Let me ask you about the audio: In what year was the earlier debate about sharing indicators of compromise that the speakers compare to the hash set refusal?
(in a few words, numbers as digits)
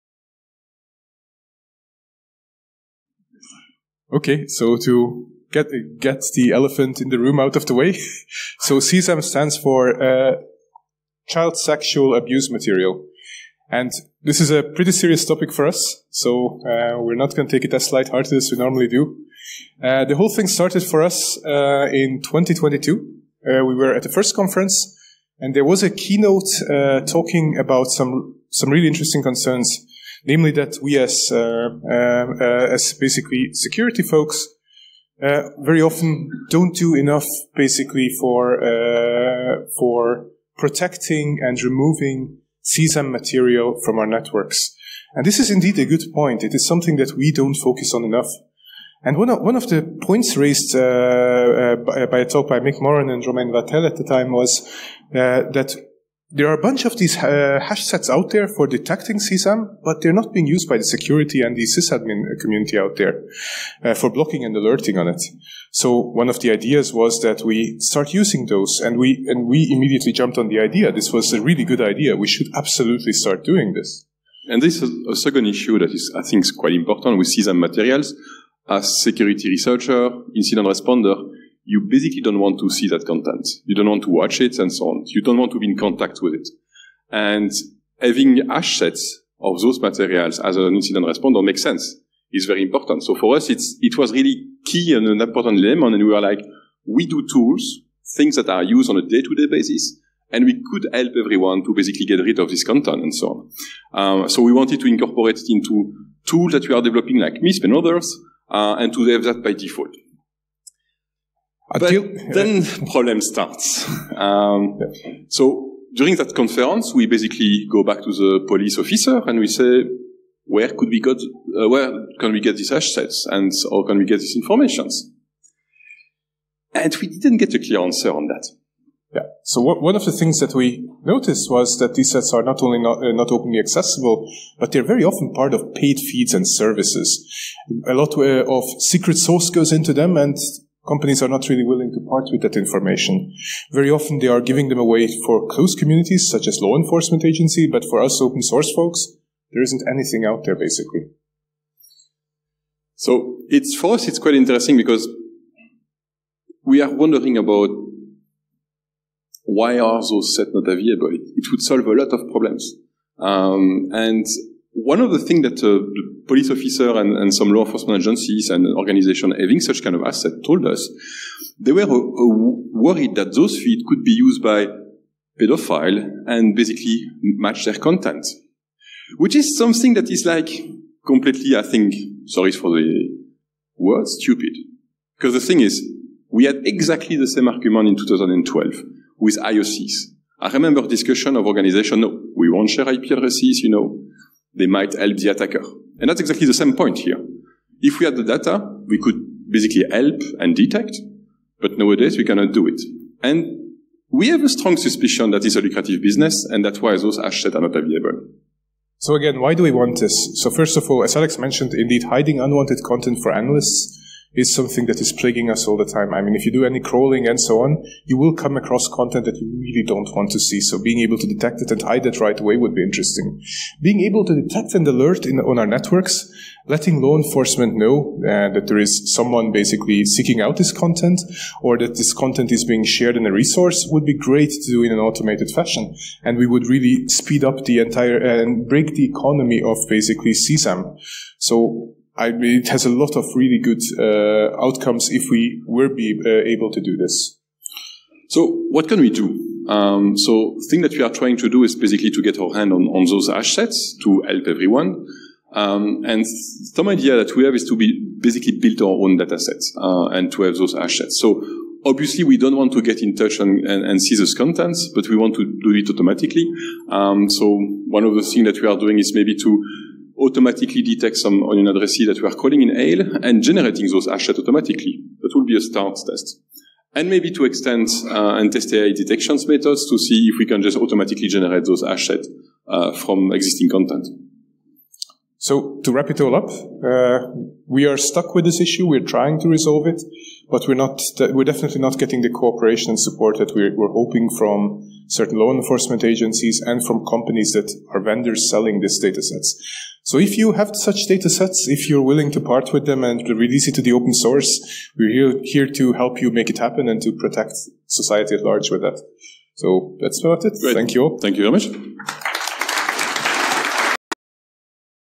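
2012.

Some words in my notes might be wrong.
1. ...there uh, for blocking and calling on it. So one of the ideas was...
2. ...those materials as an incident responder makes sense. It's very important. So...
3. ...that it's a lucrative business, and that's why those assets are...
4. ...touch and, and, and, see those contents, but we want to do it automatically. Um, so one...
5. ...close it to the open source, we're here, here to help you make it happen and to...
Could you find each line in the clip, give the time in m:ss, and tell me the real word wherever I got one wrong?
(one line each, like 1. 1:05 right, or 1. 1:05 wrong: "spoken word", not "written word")
1. 1:02 wrong: "alerting", not "calling"
2. 1:29 right
3. 3:25 right
4. 4:23 right
5. 5:03 wrong: "release", not "close".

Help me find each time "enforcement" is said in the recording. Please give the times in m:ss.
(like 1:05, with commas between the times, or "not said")
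2:26, 2:47, 3:47, 4:55.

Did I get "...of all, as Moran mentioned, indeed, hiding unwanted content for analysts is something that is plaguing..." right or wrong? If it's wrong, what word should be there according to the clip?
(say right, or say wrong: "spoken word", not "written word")
wrong: "Alex", not "Moran".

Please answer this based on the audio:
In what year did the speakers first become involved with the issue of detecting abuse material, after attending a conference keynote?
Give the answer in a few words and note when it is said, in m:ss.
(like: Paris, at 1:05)
2022, at 0:22.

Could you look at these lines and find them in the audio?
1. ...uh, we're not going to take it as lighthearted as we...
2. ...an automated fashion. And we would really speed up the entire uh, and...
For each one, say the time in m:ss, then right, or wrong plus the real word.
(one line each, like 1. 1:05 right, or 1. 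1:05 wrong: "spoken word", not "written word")
1. 0:16 right
2. 3:54 right.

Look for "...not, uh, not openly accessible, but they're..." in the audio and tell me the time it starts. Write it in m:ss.
2:12.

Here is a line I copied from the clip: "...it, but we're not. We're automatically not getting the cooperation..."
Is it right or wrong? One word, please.
wrong.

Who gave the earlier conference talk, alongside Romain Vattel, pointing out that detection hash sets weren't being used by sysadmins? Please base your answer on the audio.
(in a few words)
Mick Moran.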